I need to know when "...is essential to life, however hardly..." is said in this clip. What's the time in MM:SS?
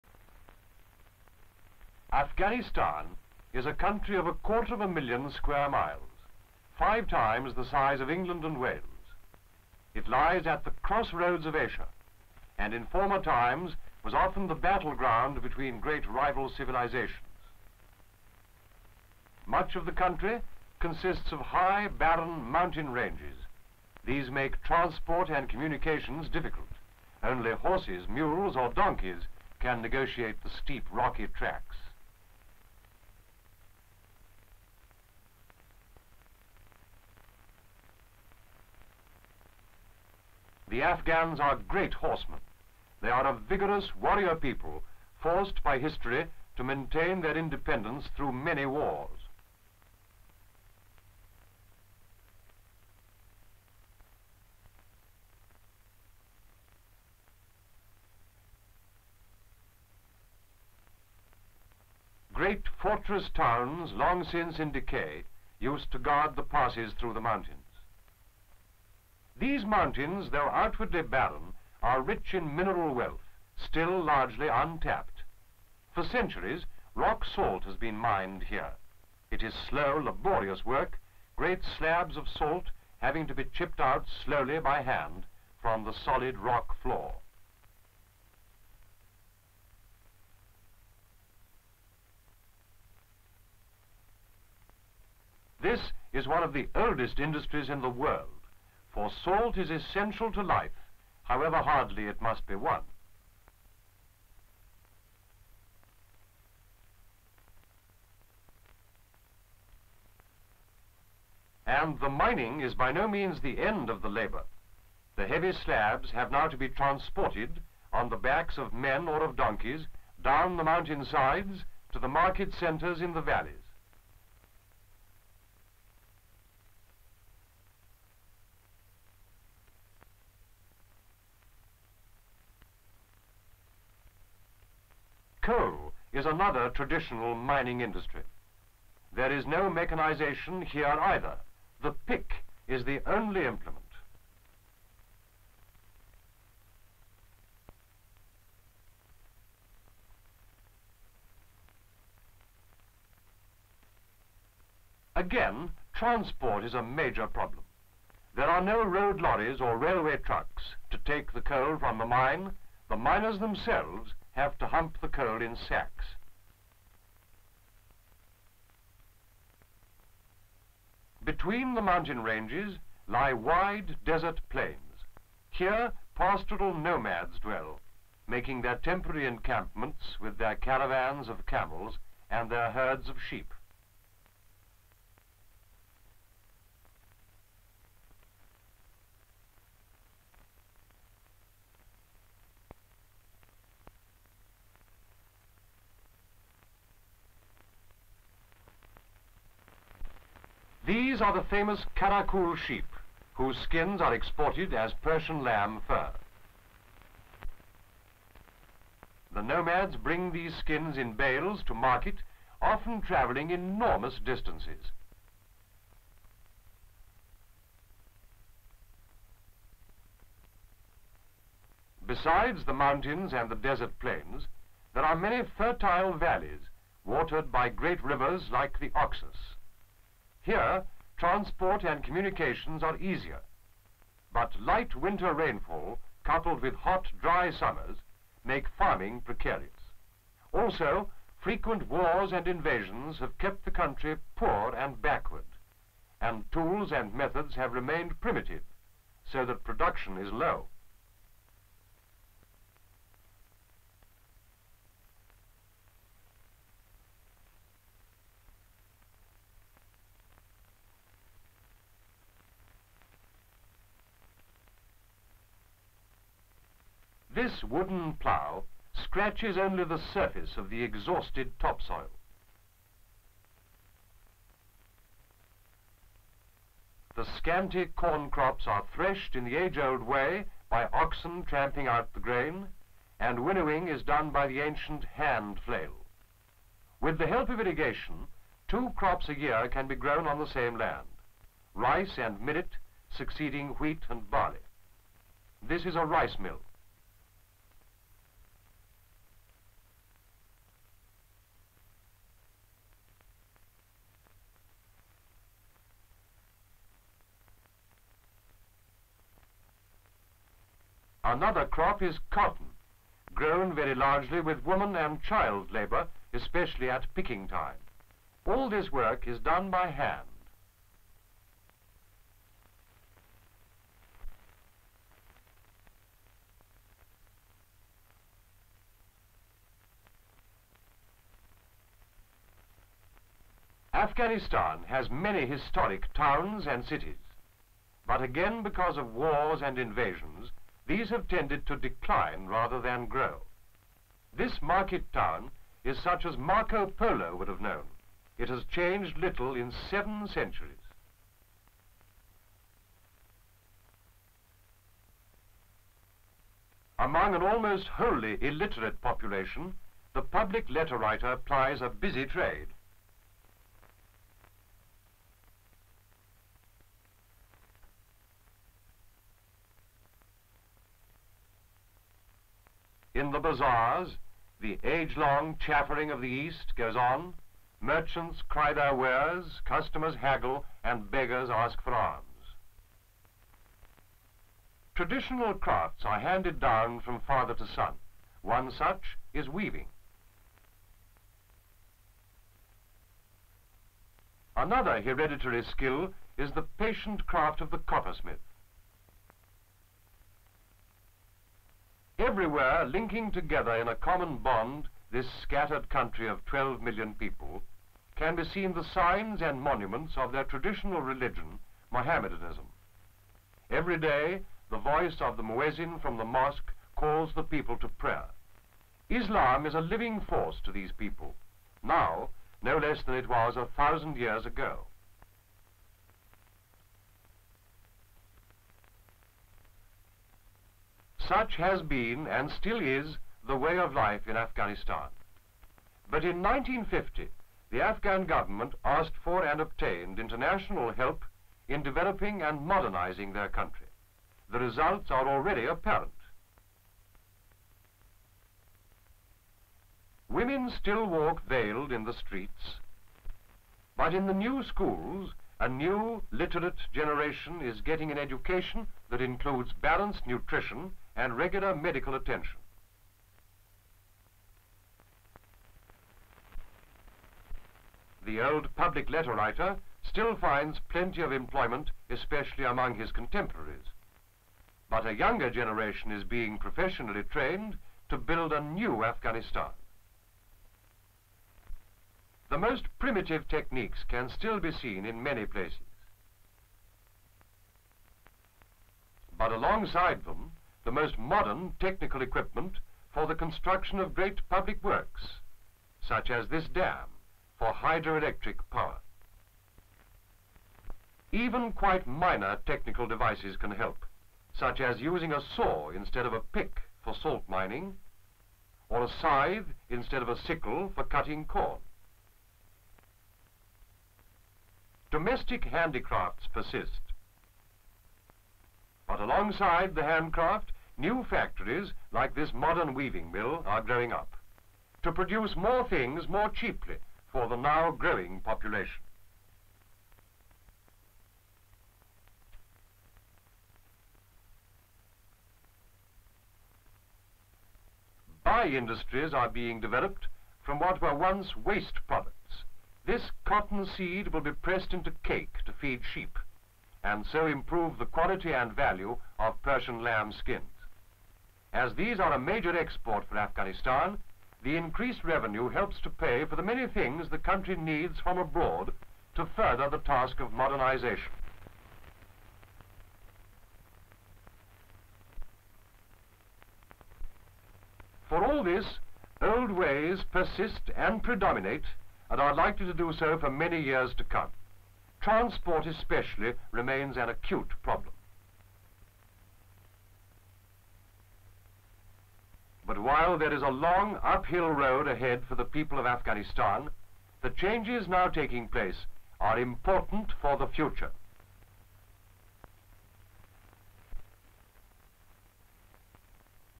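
01:39.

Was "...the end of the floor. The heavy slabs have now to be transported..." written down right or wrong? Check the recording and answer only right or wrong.
wrong.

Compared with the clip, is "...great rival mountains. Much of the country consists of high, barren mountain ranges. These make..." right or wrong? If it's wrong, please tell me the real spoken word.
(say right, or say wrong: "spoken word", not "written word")
wrong: "civilizations", not "mountains".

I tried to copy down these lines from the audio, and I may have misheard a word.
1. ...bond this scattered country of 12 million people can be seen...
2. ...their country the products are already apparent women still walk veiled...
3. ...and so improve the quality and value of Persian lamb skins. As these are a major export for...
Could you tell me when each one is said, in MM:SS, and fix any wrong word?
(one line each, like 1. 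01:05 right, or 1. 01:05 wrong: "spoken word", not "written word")
1. 06:44 right
2. 07:23 wrong: "results", not "products"
3. 09:07 right.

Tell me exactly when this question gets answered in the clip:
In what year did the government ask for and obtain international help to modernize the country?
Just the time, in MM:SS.
07:16.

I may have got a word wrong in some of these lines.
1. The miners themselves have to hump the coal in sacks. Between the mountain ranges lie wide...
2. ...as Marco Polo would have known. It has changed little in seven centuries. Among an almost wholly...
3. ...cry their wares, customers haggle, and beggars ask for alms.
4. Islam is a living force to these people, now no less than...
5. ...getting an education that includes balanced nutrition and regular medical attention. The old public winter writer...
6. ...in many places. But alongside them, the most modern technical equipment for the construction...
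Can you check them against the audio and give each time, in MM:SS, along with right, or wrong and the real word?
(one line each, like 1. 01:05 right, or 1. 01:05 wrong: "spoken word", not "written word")
1. 02:42 right
2. 05:46 right
3. 06:18 right
4. 06:59 right
5. 07:37 wrong: "letter", not "winter"
6. 08:05 right.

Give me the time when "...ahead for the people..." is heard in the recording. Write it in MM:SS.
09:45.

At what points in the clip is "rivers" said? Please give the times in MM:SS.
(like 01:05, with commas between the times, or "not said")
03:48.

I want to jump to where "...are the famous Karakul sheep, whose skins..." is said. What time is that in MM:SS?
03:21.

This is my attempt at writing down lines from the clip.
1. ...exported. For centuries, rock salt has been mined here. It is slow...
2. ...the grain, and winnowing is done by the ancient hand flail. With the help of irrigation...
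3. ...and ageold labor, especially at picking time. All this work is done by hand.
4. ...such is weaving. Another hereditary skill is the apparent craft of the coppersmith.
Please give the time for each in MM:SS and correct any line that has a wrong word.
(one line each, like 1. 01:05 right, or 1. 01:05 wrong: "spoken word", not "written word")
1. 01:14 wrong: "untapped", not "exported"
2. 04:42 right
3. 05:14 wrong: "child", not "ageold"
4. 06:28 wrong: "patient", not "apparent".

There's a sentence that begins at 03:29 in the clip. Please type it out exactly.
The nomads bring these skins in bales to market, often traveling enormous distances.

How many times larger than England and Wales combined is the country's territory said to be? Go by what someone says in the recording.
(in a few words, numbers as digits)
5.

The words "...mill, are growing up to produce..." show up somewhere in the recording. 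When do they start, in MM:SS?
08:43.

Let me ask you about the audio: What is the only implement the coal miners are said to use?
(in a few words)
The pick.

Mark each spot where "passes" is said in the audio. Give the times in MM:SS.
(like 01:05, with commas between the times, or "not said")
01:06.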